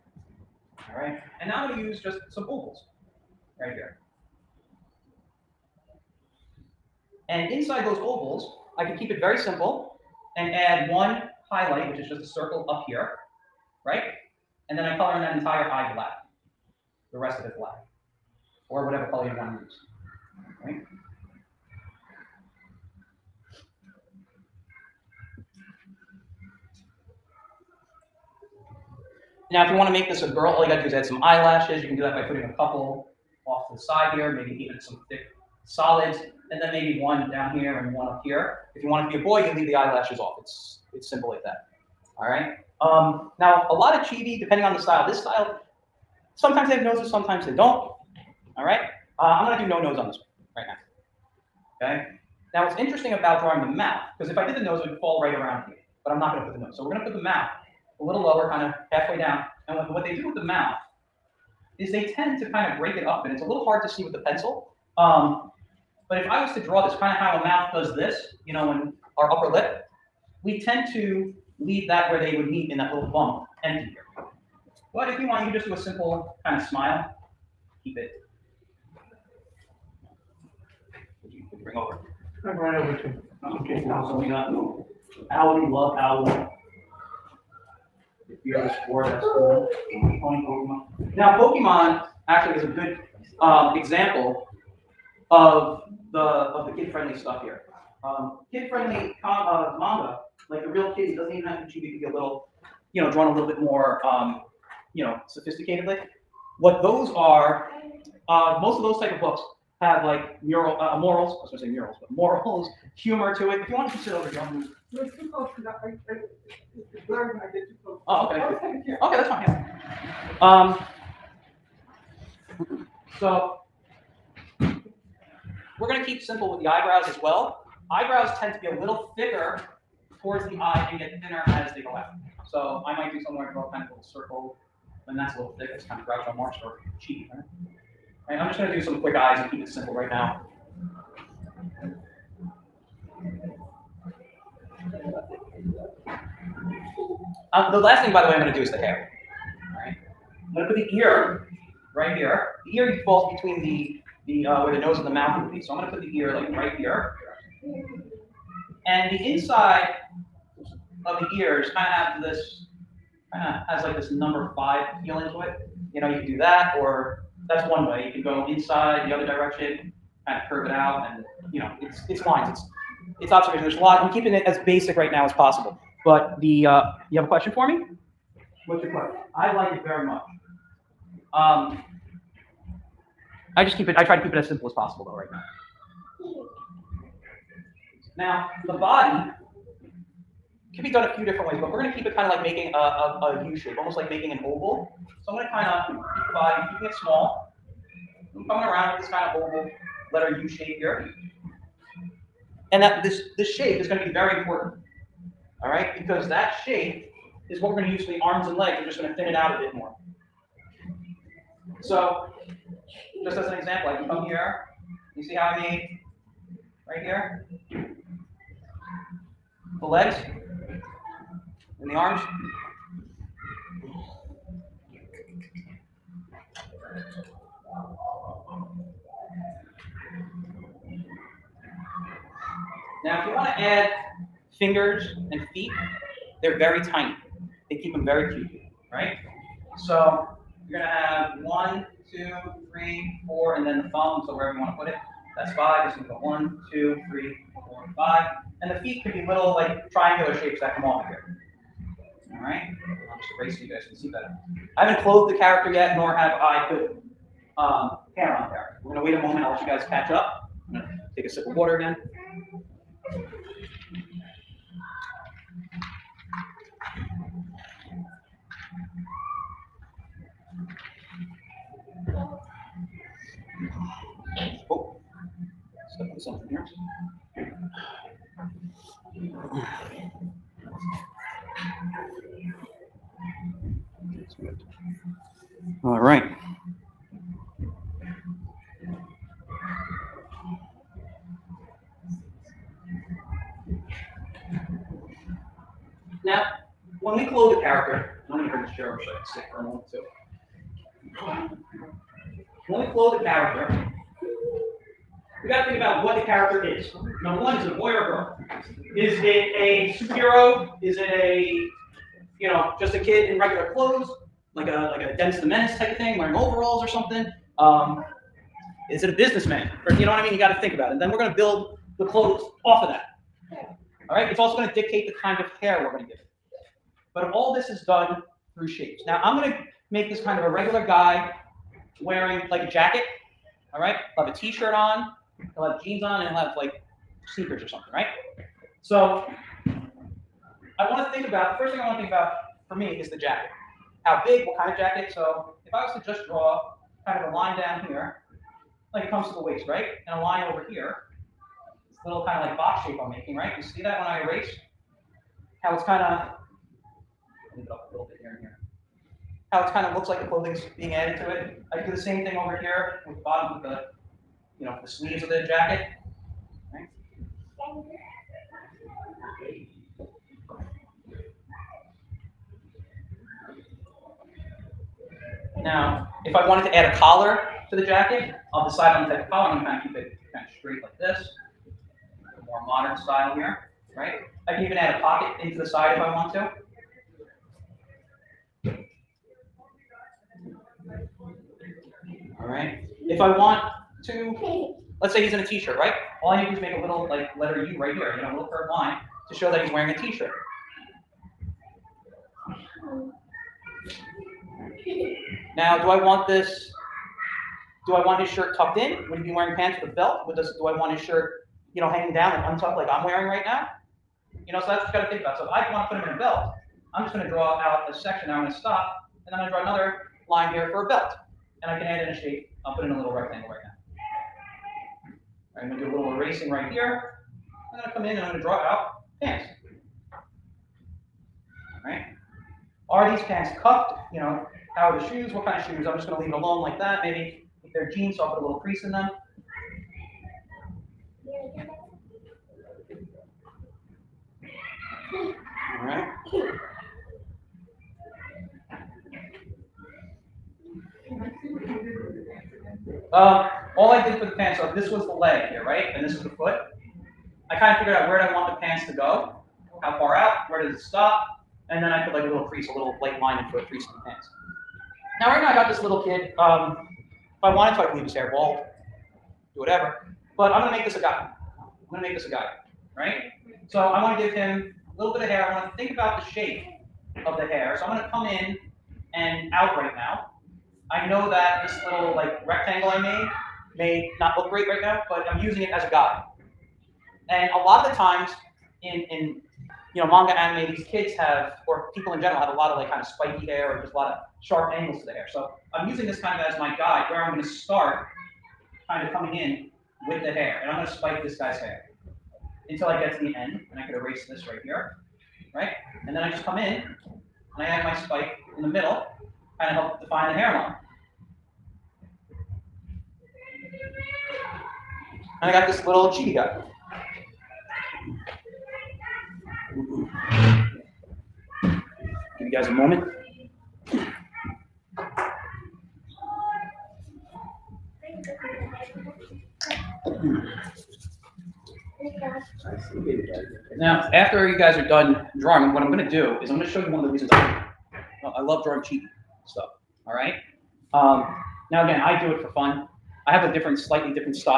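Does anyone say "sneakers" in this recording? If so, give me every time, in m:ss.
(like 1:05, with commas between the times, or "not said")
5:37.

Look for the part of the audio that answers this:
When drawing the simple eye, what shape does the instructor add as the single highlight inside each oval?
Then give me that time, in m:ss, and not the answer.
0:12.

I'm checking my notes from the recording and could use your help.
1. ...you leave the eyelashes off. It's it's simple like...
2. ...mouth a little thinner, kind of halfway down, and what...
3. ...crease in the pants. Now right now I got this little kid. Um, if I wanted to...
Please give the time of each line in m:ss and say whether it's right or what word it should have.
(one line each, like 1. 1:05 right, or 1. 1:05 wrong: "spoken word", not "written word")
1. 0:39 right
2. 0:57 wrong: "lower", not "thinner"
3. 7:43 right.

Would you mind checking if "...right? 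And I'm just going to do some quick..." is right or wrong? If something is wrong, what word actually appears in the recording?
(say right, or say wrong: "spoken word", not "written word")
right.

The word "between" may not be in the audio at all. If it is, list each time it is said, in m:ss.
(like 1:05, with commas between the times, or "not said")
2:33.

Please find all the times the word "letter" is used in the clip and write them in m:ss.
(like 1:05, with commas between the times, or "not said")
3:20, 6:37.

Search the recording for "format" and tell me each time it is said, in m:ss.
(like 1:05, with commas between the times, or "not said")
not said.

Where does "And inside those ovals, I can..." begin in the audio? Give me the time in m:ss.
0:07.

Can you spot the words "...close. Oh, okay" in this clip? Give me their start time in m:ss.
1:57.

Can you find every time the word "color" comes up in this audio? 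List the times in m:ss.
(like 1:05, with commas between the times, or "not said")
0:14, 0:19.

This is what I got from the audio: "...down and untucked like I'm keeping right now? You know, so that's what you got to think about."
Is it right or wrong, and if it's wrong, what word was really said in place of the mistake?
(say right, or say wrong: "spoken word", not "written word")
wrong: "wearing", not "keeping".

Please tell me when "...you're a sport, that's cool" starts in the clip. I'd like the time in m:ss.
1:28.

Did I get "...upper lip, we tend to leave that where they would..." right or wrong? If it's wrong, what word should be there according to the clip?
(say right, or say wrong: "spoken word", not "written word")
right.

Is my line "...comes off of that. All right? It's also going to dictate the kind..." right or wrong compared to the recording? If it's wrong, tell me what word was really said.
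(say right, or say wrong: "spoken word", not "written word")
wrong: "clothes", not "comes".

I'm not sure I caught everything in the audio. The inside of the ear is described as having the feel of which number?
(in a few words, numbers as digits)
5.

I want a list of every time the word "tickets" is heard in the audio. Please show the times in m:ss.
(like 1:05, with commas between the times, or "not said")
not said.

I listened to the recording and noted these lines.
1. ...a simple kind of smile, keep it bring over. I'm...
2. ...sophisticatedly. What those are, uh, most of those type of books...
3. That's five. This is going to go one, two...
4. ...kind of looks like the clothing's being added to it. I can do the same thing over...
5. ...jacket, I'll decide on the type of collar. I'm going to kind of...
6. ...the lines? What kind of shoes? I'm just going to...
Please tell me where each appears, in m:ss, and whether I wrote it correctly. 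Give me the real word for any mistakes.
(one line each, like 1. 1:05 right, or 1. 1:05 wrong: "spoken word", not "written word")
1. 1:15 right
2. 1:45 right
3. 4:05 right
4. 5:59 right
5. 6:17 right
6. 7:14 wrong: "shoes", not "lines".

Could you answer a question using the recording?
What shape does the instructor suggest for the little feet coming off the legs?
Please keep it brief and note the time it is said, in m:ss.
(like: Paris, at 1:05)
Triangular, at 4:09.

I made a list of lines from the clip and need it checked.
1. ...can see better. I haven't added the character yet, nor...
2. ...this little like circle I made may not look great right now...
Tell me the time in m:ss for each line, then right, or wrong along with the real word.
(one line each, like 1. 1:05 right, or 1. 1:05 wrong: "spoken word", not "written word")
1. 4:13 wrong: "clothed", not "added"
2. 8:01 wrong: "rectangle", not "circle".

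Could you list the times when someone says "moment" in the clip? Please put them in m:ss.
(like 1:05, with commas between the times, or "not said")
4:19, 8:42.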